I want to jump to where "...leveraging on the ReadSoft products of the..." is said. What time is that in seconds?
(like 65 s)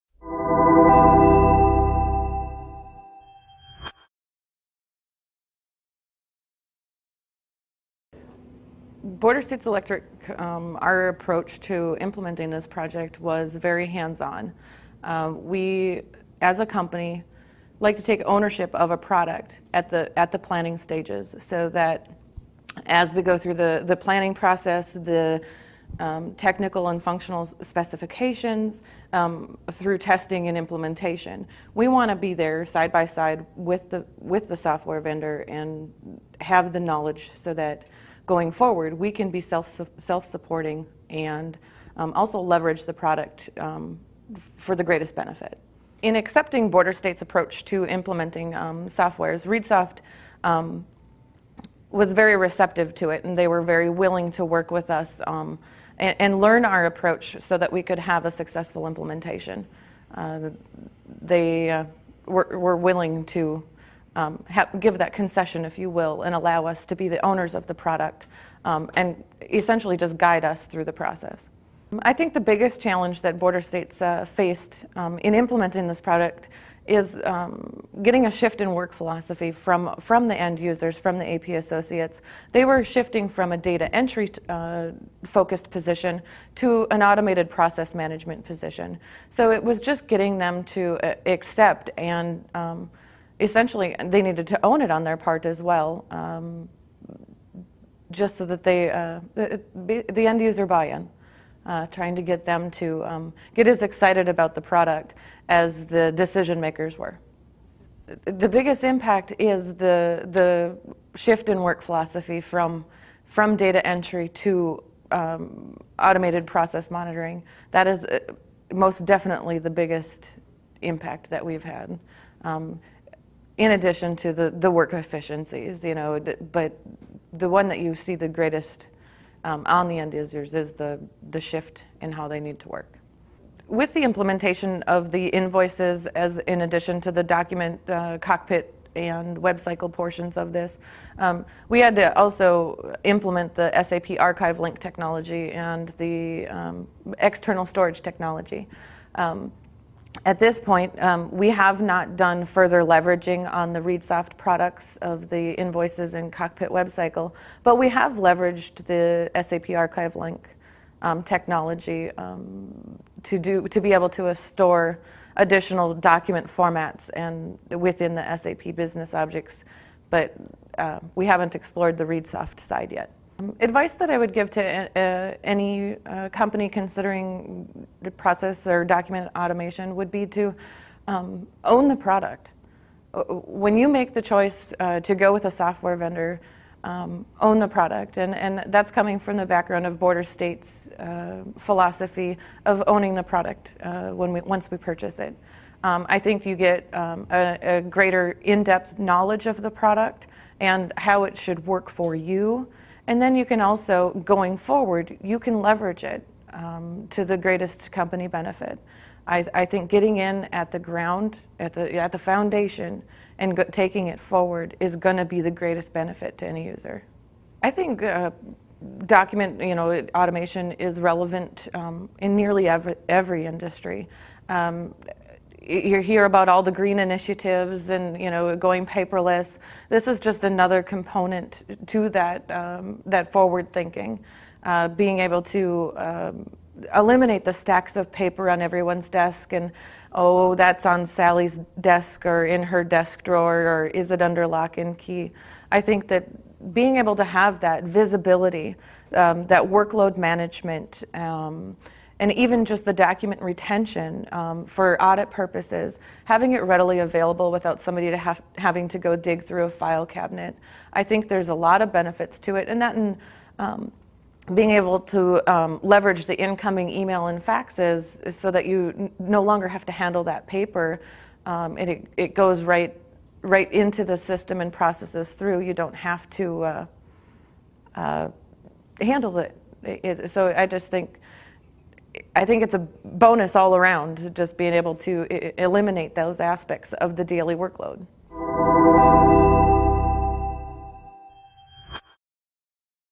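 152 s.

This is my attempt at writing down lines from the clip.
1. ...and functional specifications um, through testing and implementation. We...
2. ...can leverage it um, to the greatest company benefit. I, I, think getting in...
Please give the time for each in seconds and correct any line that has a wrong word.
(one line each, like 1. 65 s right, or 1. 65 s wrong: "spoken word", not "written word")
1. 26 s right
2. 205 s right.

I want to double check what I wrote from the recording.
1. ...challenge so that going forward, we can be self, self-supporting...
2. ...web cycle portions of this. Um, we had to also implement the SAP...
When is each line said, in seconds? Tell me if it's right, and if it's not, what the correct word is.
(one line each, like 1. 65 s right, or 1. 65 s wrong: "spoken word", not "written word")
1. 36 s wrong: "knowledge", not "challenge"
2. 139 s right.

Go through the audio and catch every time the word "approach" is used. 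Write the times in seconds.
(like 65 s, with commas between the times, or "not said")
11 s, 47 s, 56 s.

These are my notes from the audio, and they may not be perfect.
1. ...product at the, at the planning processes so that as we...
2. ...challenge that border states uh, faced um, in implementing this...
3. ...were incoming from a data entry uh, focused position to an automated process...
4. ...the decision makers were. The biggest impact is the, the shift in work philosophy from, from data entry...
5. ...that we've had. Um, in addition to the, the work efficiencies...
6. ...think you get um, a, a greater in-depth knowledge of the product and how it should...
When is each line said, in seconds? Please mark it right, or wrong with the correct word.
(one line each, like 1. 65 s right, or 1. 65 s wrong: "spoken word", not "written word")
1. 18 s wrong: "stages", not "processes"
2. 72 s right
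3. 82 s wrong: "shifting", not "incoming"
4. 105 s right
5. 121 s right
6. 196 s right.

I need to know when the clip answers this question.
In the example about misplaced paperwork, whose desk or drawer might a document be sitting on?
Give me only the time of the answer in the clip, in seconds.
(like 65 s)
241 s.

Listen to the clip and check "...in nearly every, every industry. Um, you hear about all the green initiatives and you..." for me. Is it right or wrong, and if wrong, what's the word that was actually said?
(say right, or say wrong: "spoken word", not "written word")
right.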